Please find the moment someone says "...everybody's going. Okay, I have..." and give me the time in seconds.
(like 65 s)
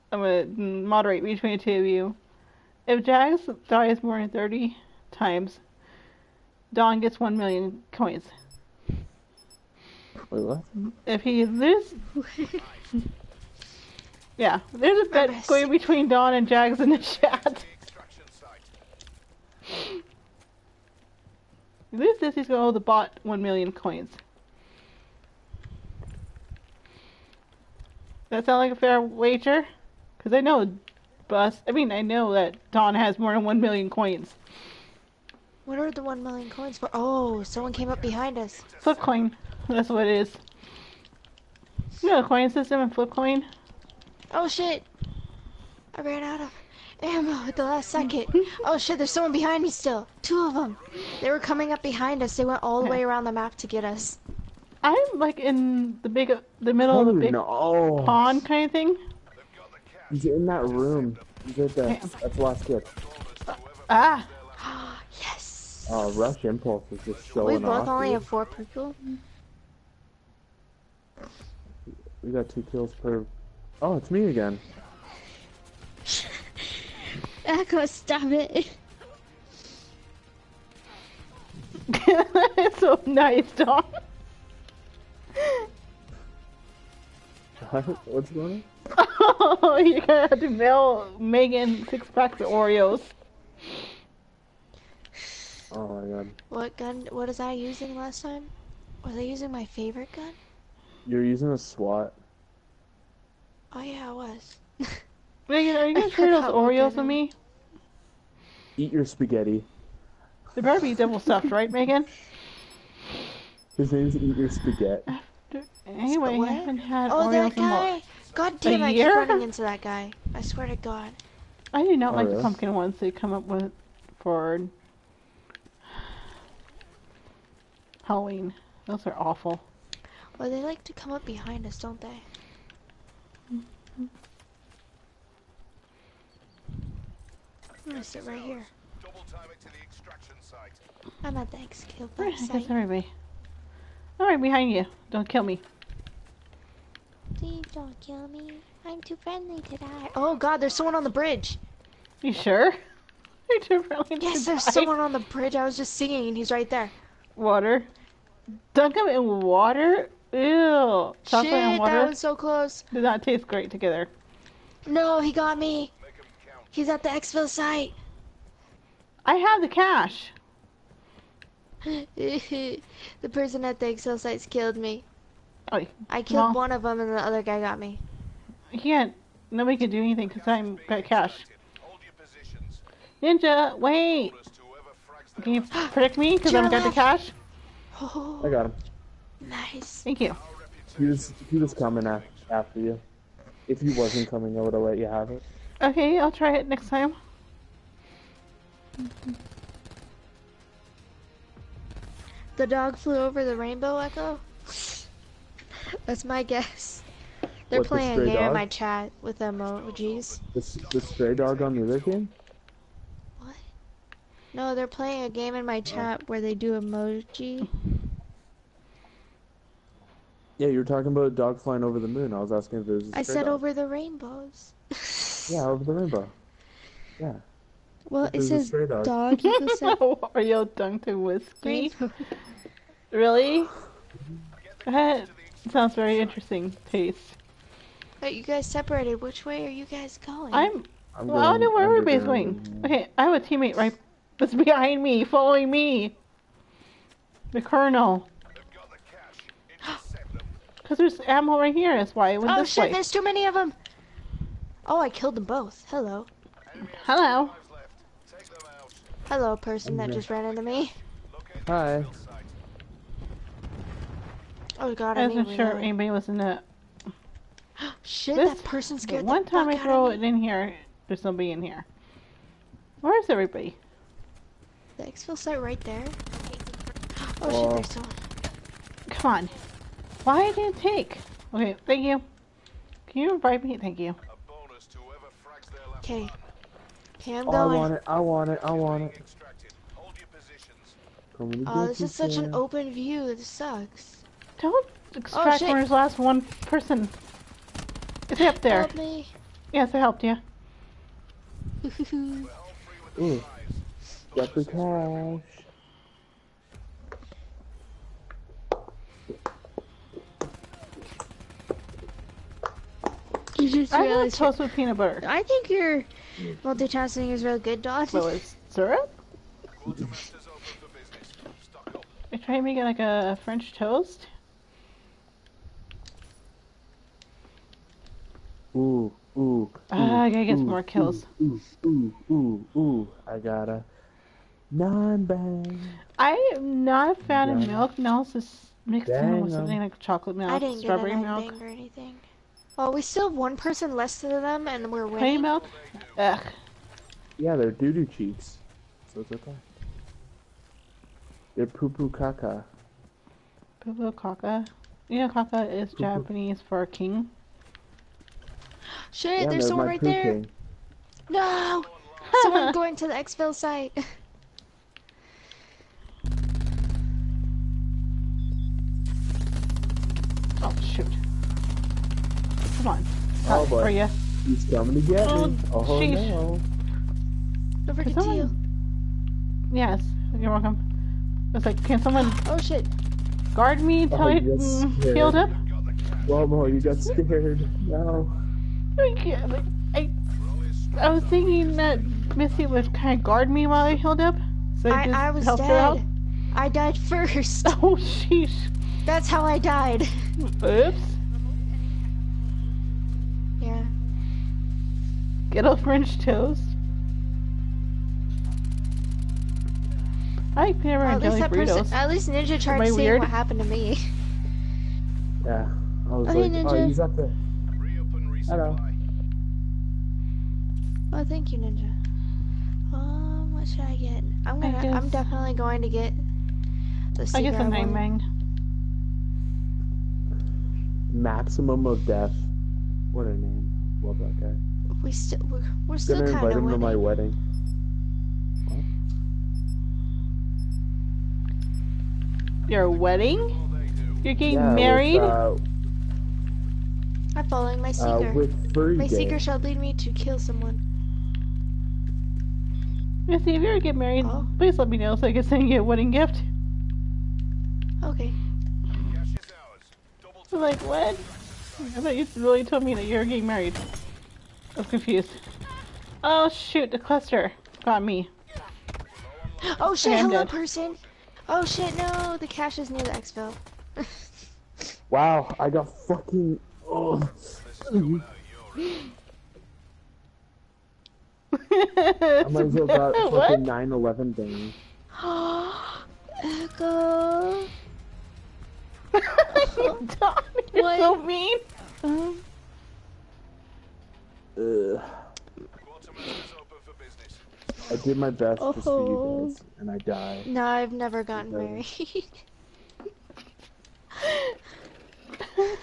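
241 s.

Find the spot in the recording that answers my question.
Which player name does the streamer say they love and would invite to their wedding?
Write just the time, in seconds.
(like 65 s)
431 s.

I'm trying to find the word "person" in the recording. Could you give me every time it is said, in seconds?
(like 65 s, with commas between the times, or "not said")
173 s, 259 s, 268 s, 296 s, 343 s, 470 s.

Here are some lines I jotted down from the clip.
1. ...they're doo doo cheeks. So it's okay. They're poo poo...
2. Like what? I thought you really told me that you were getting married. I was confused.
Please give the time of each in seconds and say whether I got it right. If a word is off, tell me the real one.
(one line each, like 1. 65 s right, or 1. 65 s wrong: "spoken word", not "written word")
1. 347 s right
2. 460 s right.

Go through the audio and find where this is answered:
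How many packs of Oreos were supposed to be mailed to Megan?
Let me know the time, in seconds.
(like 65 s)
91 s.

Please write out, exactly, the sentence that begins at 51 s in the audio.
They were coming up behind us.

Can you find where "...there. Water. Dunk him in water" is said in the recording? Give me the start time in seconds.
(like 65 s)
156 s.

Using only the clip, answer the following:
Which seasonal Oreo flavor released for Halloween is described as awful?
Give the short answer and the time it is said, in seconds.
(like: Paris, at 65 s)
Pumpkin, at 122 s.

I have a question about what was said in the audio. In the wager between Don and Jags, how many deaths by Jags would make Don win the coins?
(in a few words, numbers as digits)
More than 30.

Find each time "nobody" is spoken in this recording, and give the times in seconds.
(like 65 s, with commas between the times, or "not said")
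179 s, 271 s.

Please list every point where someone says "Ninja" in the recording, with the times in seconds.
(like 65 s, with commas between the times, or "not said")
183 s, 412 s, 416 s, 421 s.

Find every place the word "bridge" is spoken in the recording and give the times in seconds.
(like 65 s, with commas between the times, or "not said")
151 s, 155 s.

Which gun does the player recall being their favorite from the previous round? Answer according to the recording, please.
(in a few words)
SWAT.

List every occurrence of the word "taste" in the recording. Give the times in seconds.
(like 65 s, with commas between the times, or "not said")
163 s, 236 s.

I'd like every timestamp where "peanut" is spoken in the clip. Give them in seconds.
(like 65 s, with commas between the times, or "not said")
314 s, 410 s.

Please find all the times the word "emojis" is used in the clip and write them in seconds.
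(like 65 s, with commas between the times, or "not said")
209 s, 216 s.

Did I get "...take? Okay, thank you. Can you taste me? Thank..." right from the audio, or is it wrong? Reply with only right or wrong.
wrong.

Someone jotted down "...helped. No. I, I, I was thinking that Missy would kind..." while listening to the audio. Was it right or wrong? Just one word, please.
wrong.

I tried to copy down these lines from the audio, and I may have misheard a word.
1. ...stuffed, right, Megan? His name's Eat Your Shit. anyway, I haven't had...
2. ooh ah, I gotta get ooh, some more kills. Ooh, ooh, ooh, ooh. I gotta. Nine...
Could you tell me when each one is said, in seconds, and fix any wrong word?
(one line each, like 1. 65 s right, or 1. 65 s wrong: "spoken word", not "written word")
1. 111 s wrong: "Spaghetti", not "Shit"
2. 329 s right.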